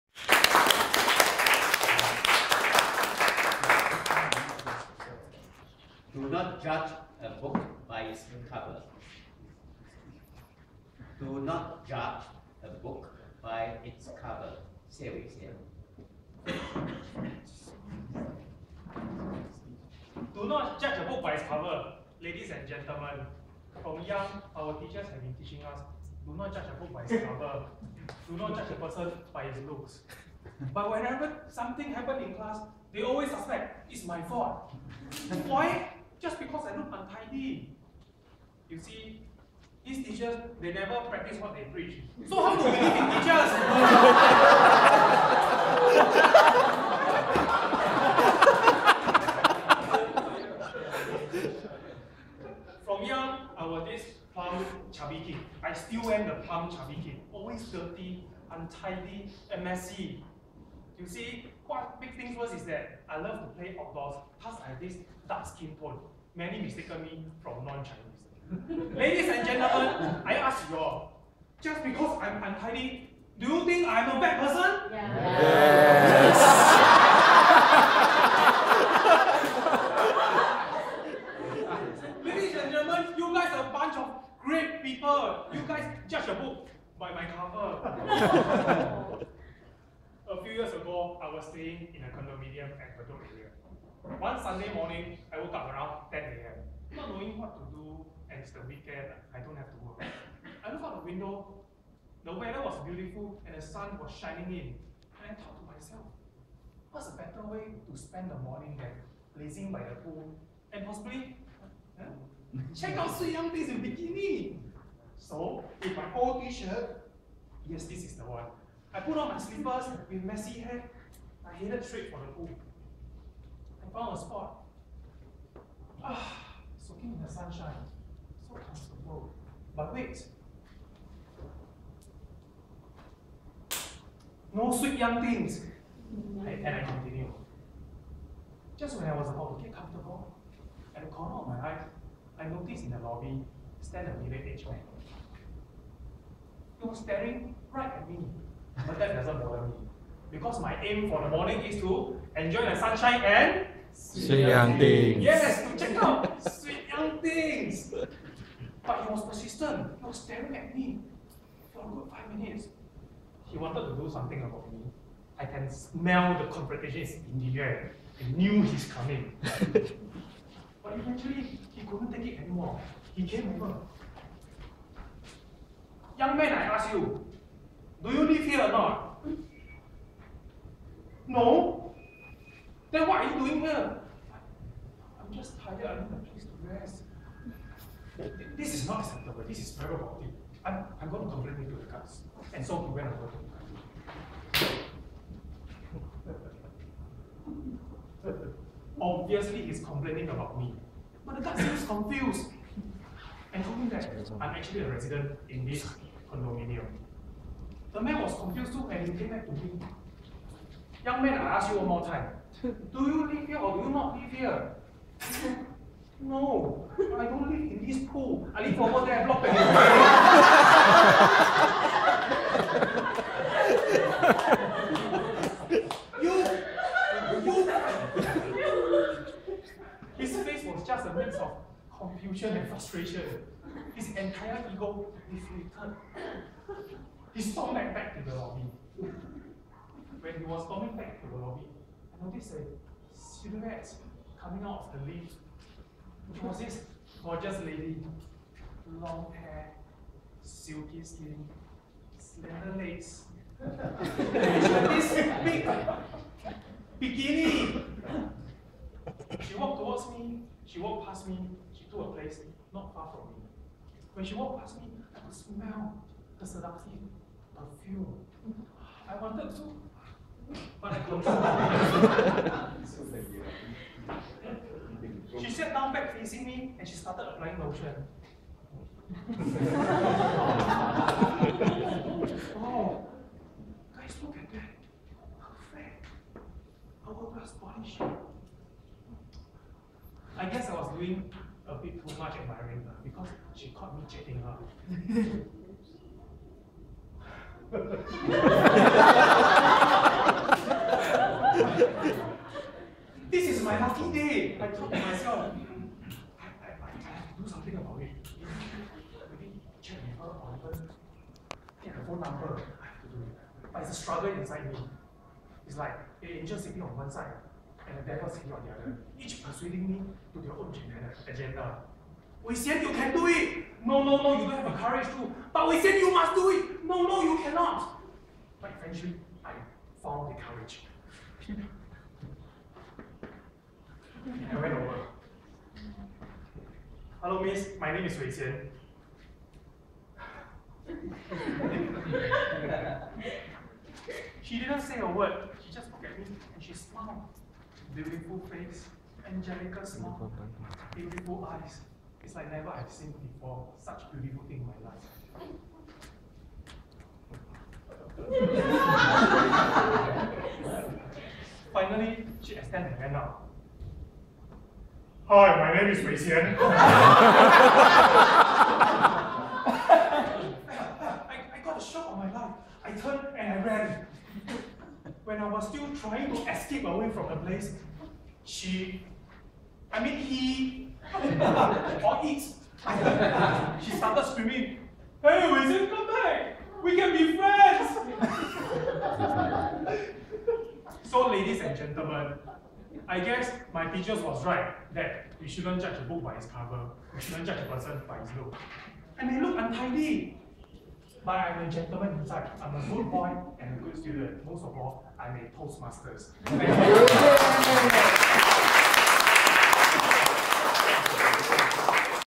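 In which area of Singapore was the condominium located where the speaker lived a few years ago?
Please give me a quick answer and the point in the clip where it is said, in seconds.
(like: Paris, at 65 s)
Bedok, at 92 s.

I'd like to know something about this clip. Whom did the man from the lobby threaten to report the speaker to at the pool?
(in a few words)
the guards.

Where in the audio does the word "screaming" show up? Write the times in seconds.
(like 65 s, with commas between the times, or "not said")
384 s.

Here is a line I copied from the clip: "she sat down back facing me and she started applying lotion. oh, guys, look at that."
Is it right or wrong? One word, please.
right.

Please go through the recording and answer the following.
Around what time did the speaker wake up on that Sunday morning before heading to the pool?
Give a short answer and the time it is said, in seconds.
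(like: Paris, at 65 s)
10 a.m., at 96 s.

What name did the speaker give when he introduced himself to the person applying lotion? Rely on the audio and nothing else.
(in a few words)
Wei Qian.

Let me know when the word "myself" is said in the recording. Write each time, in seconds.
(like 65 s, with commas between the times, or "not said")
105 s, 304 s.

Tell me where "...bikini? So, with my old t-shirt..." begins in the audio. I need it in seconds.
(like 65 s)
113 s.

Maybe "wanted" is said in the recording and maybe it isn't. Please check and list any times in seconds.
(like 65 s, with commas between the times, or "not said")
163 s, 269 s.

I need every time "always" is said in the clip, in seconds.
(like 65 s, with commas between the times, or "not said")
33 s, 57 s.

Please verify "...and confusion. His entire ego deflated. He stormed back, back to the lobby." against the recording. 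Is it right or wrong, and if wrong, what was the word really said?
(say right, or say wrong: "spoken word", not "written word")
wrong: "frustration", not "confusion".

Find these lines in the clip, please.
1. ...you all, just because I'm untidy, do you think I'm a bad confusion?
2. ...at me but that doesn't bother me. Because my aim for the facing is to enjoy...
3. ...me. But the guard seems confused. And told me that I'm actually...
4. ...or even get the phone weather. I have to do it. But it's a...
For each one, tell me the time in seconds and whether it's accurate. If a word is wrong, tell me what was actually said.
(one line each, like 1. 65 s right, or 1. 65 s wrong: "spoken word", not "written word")
1. 70 s wrong: "person", not "confusion"
2. 147 s wrong: "morning", not "facing"
3. 200 s right
4. 310 s wrong: "number", not "weather".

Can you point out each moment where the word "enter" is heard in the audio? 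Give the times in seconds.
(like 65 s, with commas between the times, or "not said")
not said.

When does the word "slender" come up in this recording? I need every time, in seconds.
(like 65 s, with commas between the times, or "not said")
252 s.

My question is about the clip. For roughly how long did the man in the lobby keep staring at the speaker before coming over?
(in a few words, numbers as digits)
five minutes.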